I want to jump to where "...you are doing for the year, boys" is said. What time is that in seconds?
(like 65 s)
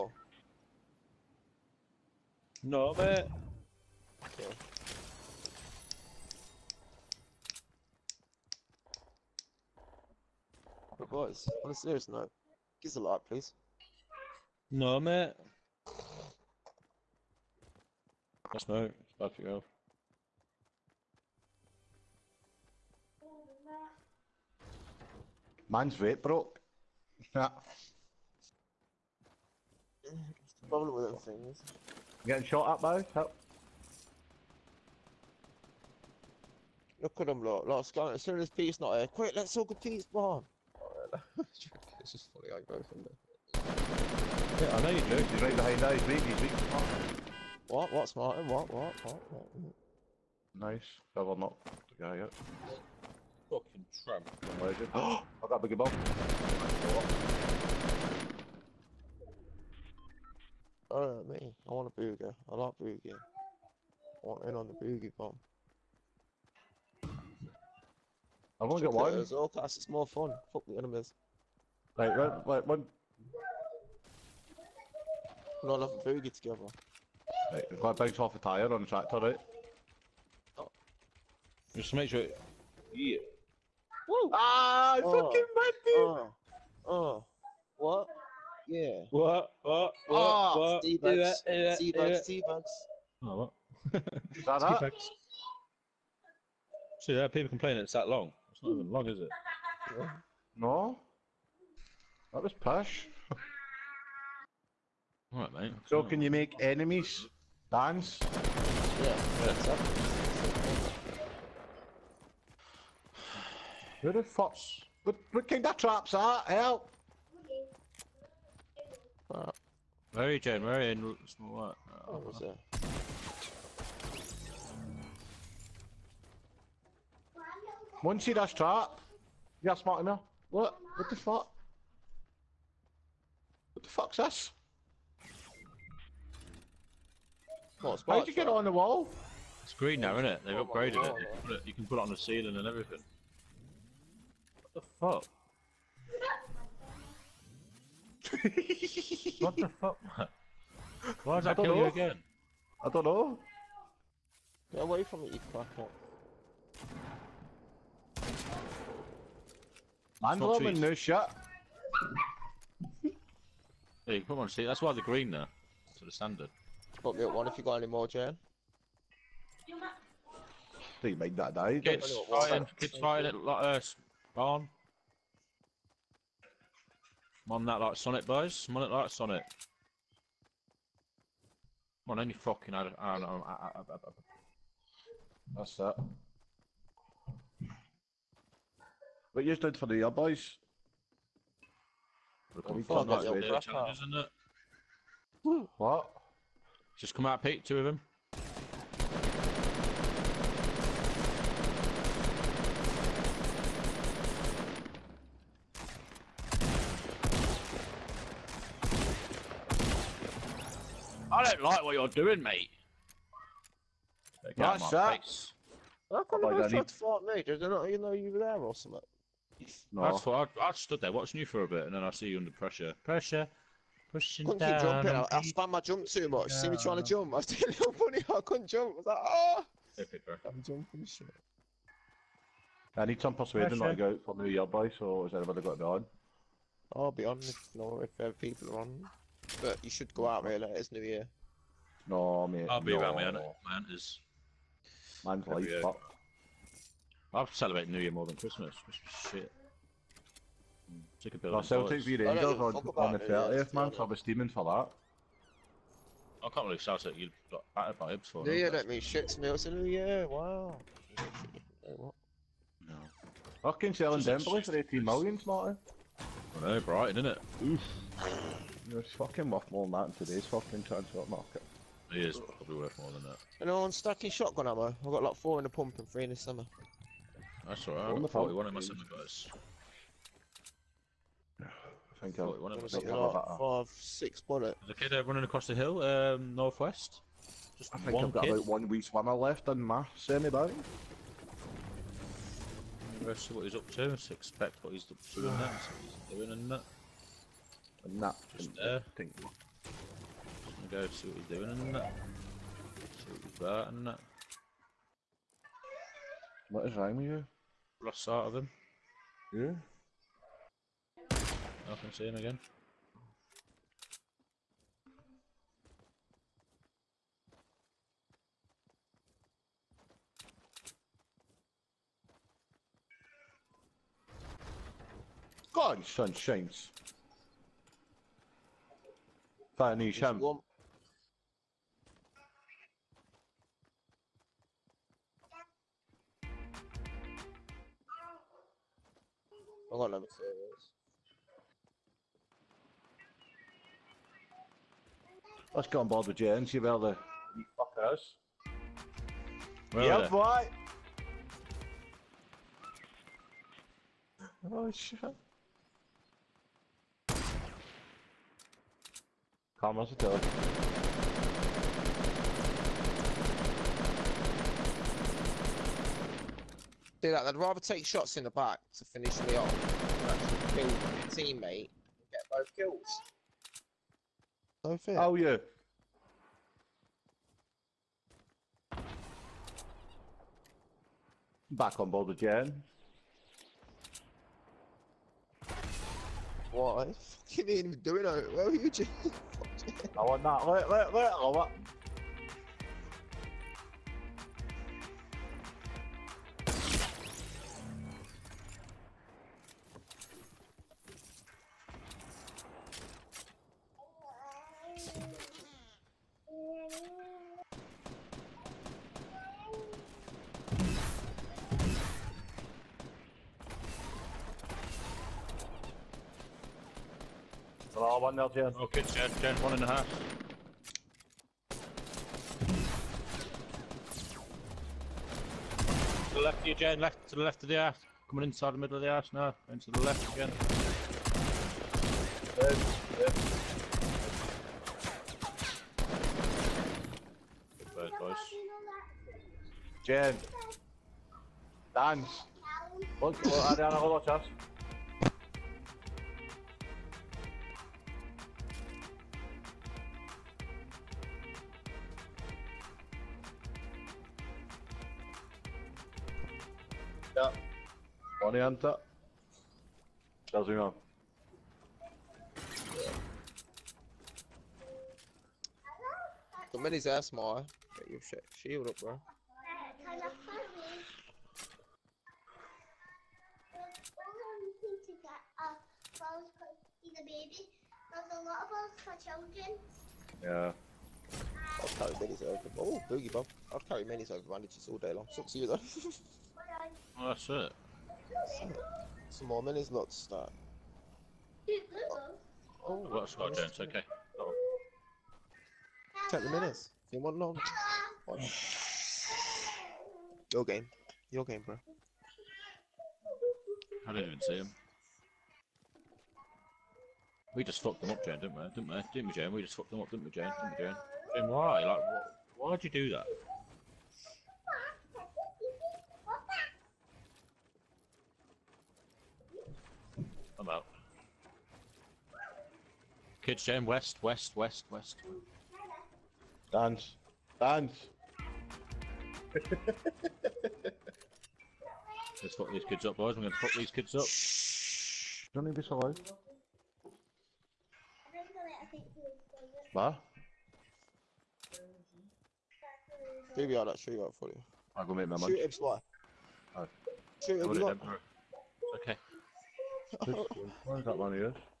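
189 s.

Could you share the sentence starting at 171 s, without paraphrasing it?
Kids fighting, kids fighting like, uh, on.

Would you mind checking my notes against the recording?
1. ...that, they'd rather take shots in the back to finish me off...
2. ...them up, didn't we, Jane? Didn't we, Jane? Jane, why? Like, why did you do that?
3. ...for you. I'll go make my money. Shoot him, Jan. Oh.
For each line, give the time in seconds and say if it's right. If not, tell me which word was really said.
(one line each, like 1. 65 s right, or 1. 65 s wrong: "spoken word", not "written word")
1. 367 s right
2. 509 s right
3. 544 s wrong: "Sly", not "Jan".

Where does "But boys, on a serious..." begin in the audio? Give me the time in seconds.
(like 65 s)
10 s.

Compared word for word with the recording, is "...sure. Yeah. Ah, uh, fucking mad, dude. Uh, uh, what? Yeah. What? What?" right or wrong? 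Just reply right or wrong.
right.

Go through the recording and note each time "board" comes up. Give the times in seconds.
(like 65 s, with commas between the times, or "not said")
346 s, 382 s.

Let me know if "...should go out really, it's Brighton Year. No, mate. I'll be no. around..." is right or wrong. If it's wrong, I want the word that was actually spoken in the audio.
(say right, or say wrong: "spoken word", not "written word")
wrong: "New", not "Brighton".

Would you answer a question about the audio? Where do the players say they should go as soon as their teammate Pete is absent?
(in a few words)
Pete's barn.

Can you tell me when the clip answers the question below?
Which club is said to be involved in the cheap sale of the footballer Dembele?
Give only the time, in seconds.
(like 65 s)
266 s.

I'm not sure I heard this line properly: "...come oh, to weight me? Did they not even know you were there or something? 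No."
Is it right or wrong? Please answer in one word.
wrong.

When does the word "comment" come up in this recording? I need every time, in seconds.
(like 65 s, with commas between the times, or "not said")
340 s.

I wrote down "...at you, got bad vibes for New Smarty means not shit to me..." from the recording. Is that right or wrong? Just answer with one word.
wrong.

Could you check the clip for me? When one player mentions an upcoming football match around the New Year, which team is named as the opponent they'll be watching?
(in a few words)
Rangers.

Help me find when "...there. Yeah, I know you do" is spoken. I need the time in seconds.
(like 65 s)
43 s.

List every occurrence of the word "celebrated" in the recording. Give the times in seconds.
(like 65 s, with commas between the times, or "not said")
247 s.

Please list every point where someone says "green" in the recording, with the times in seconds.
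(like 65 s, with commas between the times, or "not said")
139 s, 164 s.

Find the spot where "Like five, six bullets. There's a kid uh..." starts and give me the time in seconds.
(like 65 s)
283 s.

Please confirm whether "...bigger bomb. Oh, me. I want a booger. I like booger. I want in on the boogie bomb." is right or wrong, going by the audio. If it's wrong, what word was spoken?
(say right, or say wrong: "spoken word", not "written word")
right.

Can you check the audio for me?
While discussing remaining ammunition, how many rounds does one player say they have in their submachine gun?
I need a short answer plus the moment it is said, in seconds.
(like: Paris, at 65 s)
41, at 278 s.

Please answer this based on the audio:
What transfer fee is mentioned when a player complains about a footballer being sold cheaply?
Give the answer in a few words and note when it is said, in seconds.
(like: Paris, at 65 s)
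18 million, at 264 s.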